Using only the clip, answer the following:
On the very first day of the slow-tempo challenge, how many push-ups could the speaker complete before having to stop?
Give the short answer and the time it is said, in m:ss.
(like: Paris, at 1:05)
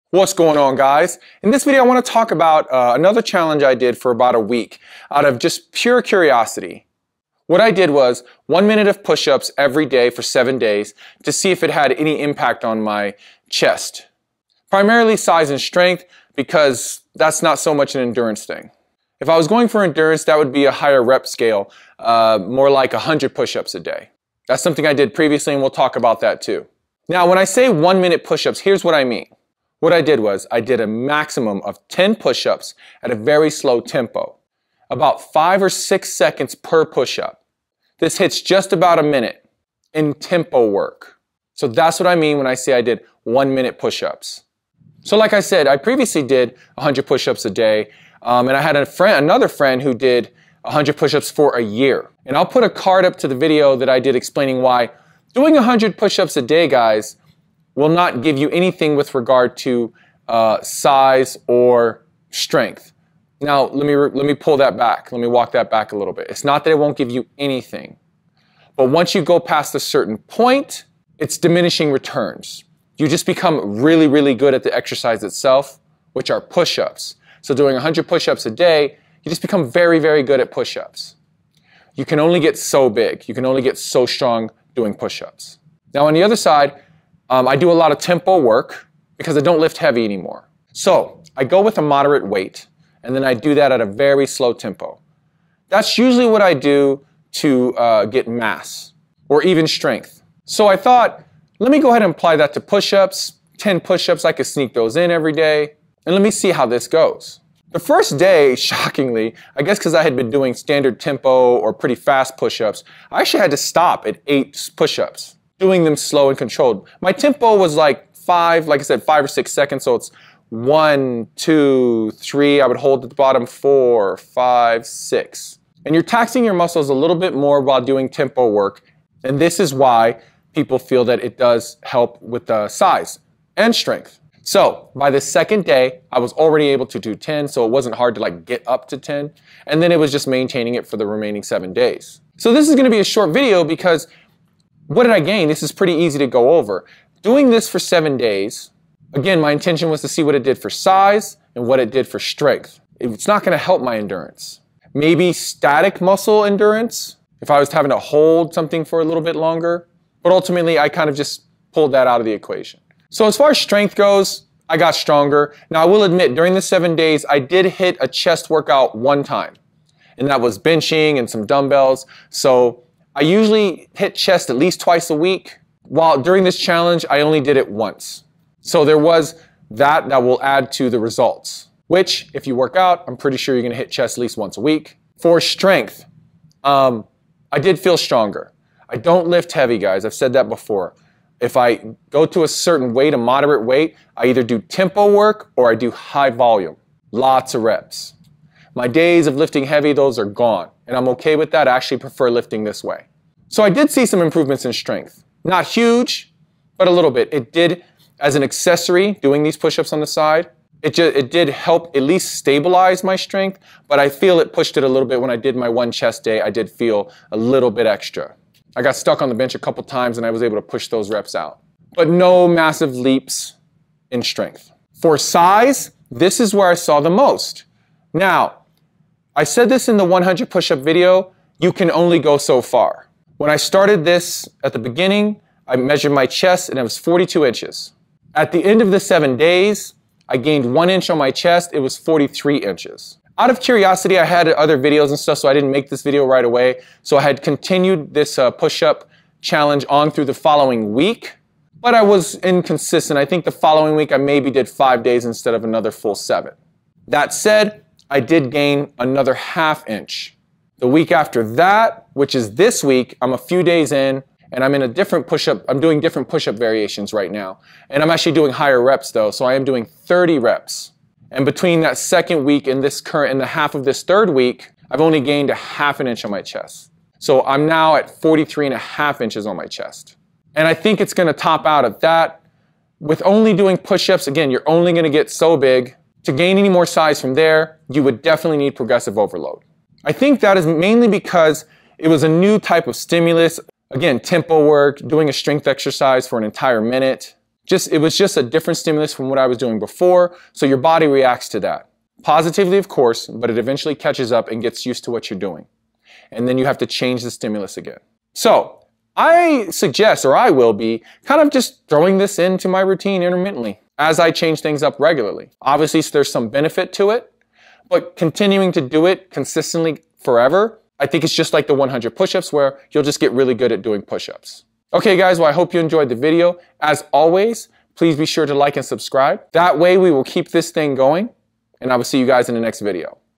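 8, at 1:54.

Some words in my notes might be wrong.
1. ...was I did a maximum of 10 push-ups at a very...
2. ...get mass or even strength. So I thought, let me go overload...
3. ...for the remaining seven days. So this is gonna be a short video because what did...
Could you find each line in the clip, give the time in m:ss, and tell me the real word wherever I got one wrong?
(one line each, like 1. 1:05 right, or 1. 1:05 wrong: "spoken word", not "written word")
1. 0:30 right
2. 1:38 wrong: "ahead", not "overload"
3. 2:20 right.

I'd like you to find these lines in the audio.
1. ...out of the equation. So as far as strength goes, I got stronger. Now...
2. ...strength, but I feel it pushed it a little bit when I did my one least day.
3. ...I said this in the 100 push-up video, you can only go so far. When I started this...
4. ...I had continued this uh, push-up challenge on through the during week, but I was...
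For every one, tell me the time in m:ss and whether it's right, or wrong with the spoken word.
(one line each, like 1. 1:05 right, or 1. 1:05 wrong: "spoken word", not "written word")
1. 2:42 right
2. 3:33 wrong: "chest", not "least"
3. 3:49 right
4. 4:07 wrong: "following", not "during".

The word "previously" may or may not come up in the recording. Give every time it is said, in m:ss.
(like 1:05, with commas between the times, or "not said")
0:25, 0:45.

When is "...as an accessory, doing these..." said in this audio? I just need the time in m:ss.
3:28.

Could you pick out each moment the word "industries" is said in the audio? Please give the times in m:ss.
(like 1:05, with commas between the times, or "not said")
not said.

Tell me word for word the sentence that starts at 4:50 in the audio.
I think that is mainly because it was a new type of stimulus.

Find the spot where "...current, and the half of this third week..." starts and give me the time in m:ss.
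4:32.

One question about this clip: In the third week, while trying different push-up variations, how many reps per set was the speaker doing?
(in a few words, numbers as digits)
30.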